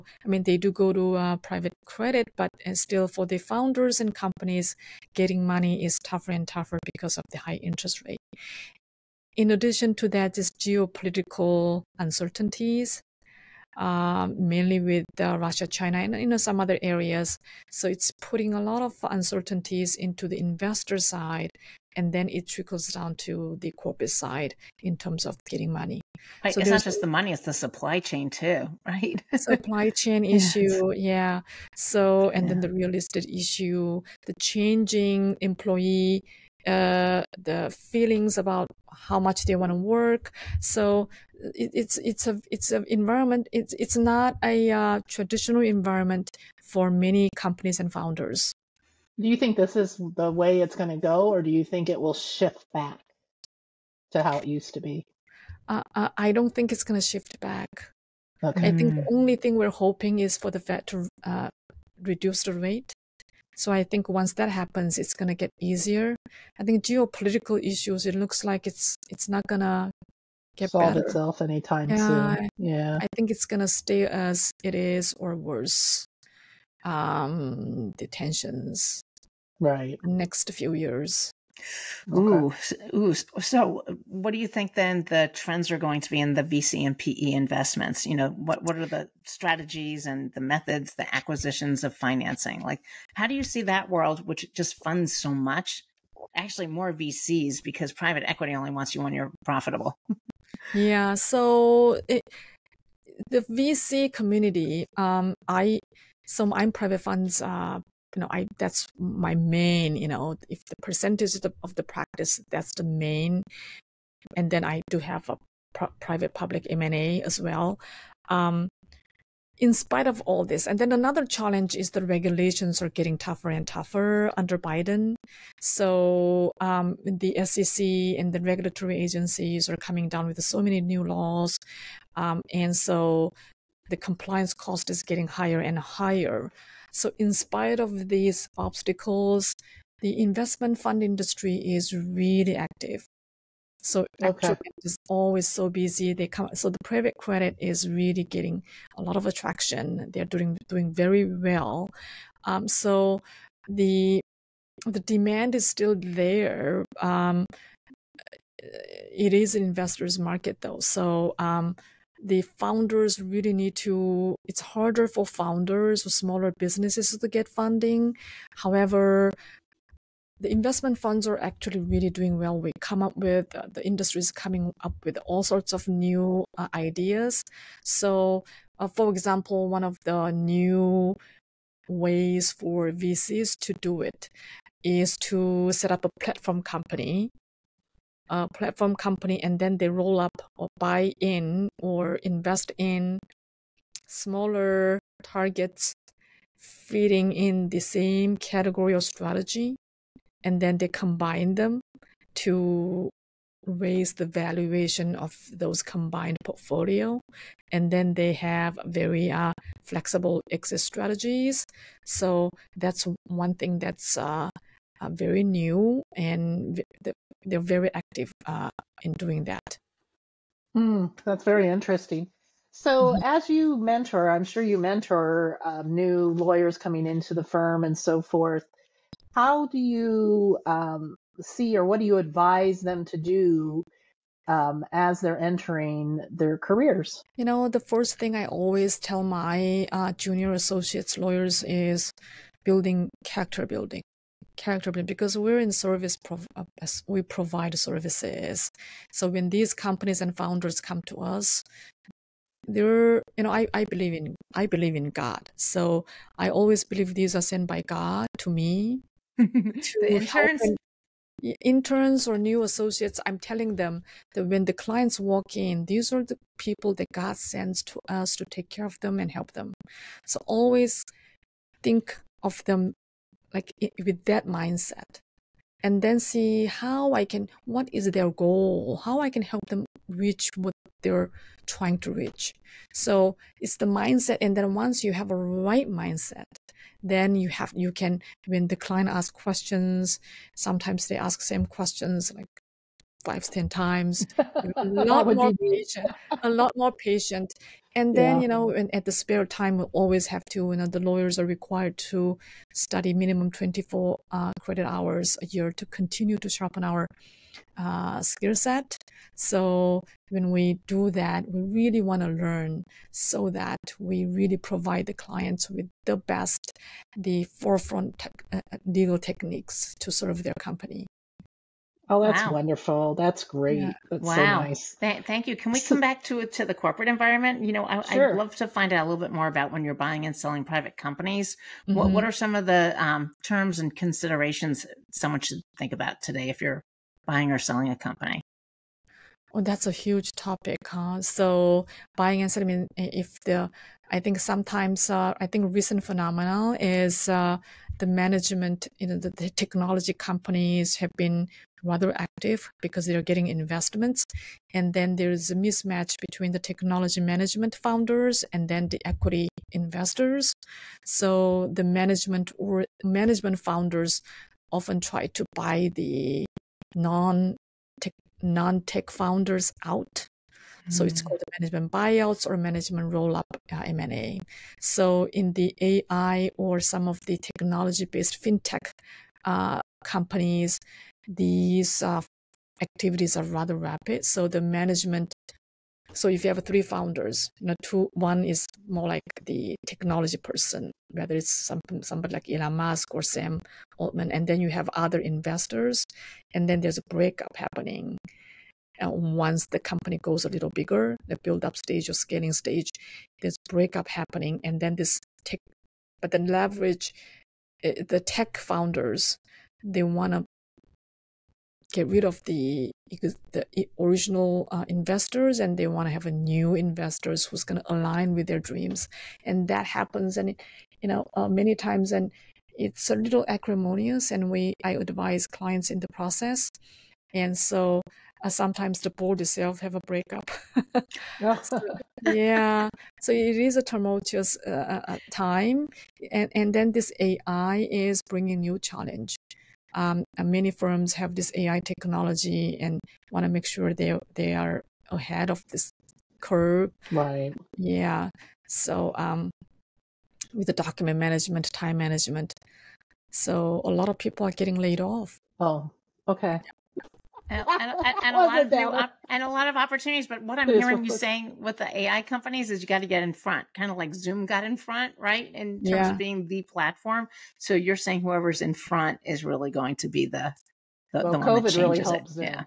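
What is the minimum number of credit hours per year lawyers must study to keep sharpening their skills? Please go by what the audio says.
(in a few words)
24.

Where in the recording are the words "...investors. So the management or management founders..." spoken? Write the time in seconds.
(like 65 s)
359 s.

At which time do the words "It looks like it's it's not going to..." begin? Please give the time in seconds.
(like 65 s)
68 s.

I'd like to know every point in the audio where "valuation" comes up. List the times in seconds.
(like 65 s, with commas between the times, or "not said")
204 s.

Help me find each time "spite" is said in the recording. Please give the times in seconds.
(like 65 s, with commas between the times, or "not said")
119 s, 137 s.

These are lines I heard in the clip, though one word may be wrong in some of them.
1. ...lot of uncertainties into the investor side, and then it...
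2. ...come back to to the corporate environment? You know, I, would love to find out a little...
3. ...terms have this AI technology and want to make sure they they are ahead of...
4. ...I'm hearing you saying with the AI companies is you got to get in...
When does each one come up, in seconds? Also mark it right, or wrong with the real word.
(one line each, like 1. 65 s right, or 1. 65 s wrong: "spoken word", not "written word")
1. 18 s right
2. 325 s right
3. 440 s wrong: "firms", not "terms"
4. 460 s right.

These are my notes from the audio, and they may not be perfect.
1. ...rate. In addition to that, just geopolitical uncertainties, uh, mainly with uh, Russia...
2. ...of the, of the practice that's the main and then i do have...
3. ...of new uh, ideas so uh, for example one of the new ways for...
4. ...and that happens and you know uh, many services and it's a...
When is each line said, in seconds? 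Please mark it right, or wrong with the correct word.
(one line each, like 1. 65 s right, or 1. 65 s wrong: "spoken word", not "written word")
1. 8 s right
2. 111 s right
3. 175 s right
4. 419 s wrong: "times", not "services".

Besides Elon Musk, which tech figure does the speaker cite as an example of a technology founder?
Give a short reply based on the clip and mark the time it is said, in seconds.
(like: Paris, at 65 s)
Sam Altman, at 393 s.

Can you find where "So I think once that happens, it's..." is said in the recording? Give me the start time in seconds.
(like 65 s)
63 s.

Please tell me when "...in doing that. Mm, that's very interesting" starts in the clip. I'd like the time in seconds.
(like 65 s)
219 s.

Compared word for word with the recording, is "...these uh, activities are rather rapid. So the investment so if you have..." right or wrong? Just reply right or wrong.
wrong.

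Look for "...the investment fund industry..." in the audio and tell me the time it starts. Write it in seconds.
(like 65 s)
140 s.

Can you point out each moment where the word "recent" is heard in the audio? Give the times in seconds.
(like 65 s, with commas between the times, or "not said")
345 s.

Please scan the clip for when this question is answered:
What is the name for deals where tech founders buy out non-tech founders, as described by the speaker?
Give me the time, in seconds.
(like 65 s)
371 s.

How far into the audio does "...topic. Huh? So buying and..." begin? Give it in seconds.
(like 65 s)
340 s.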